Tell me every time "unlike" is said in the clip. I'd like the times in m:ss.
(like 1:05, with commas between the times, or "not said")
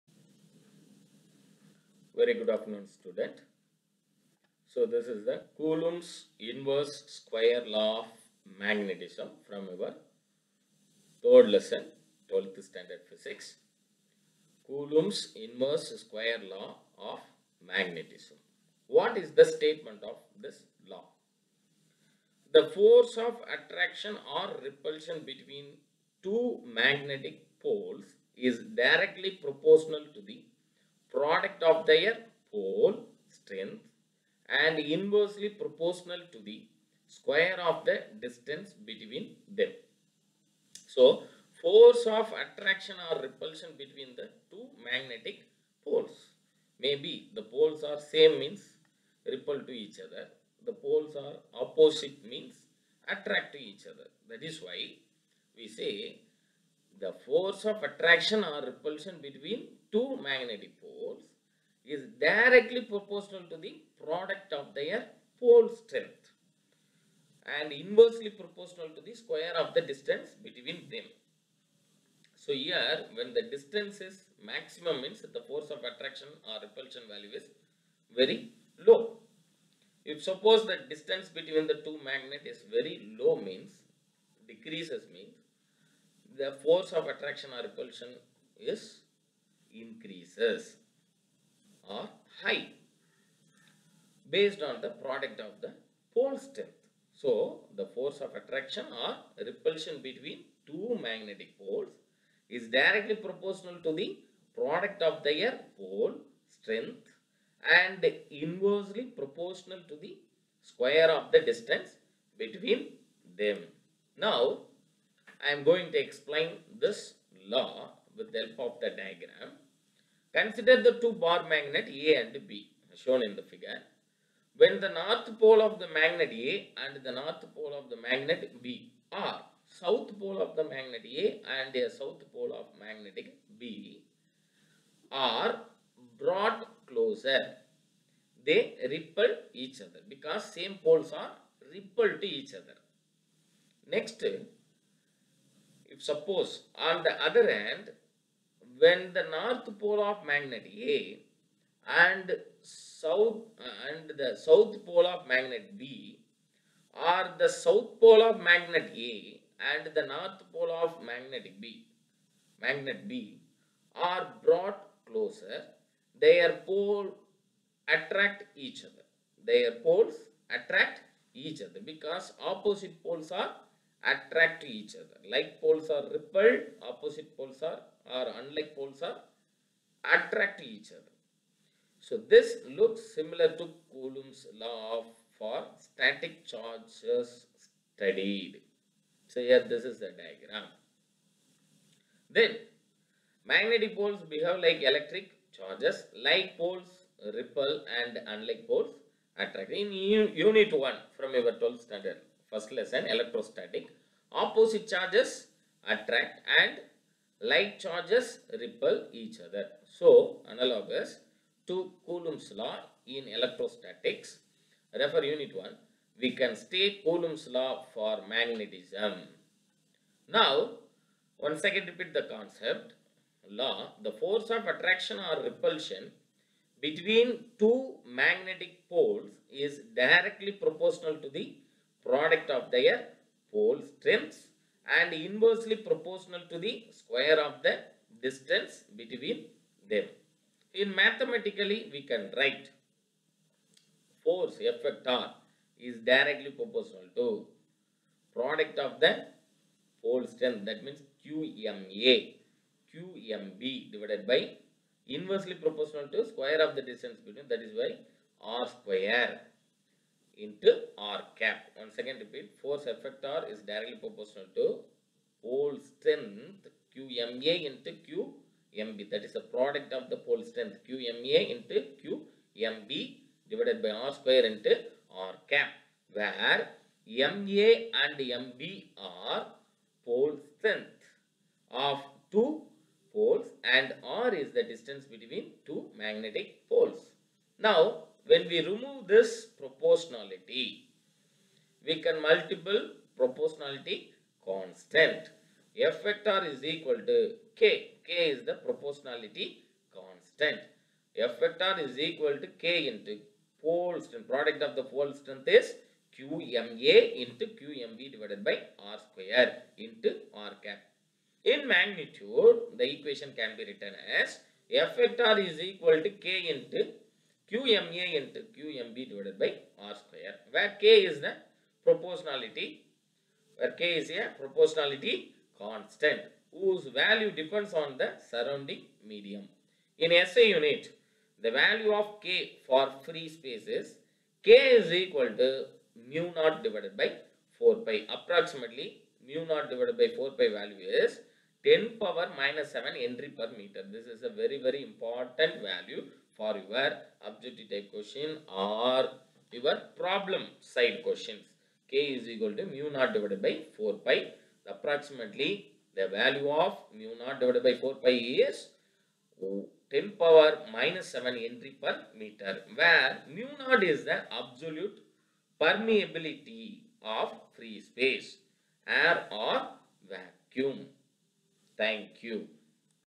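2:58, 3:18.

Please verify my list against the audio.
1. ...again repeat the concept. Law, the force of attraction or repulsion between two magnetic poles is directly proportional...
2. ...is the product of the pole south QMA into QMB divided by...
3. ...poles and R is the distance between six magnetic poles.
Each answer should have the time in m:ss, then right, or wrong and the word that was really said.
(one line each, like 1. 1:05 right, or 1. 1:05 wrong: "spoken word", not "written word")
1. 3:41 right
2. 4:29 wrong: "strength", not "south"
3. 4:43 wrong: "two", not "six".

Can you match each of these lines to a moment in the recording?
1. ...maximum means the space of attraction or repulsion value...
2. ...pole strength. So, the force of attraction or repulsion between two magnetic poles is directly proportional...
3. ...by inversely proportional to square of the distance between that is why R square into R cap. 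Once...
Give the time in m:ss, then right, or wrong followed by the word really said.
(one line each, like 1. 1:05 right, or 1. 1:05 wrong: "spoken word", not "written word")
1. 1:14 wrong: "force", not "space"
2. 1:36 right
3. 4:14 right.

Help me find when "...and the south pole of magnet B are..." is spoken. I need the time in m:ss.
2:33.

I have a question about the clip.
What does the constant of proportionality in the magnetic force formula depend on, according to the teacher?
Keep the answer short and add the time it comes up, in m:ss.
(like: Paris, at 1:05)
Surrounding medium, at 5:28.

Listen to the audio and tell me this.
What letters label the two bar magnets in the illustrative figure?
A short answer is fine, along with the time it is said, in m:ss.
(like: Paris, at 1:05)
A and B, at 2:01.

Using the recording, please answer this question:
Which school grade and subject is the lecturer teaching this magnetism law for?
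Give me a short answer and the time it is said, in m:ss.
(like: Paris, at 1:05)
12th standard physics, at 0:12.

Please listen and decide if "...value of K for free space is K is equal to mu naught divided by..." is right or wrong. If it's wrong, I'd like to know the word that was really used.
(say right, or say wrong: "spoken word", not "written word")
right.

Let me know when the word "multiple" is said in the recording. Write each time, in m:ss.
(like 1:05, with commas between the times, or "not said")
4:52.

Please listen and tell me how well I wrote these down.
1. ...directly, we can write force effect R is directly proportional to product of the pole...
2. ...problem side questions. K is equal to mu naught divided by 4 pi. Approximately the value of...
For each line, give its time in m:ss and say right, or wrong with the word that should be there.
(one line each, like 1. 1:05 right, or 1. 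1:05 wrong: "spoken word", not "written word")
1. 4:00 wrong: "mathematically", not "directly"
2. 5:49 right.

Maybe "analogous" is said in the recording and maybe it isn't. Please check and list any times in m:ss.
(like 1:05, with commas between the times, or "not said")
3:30.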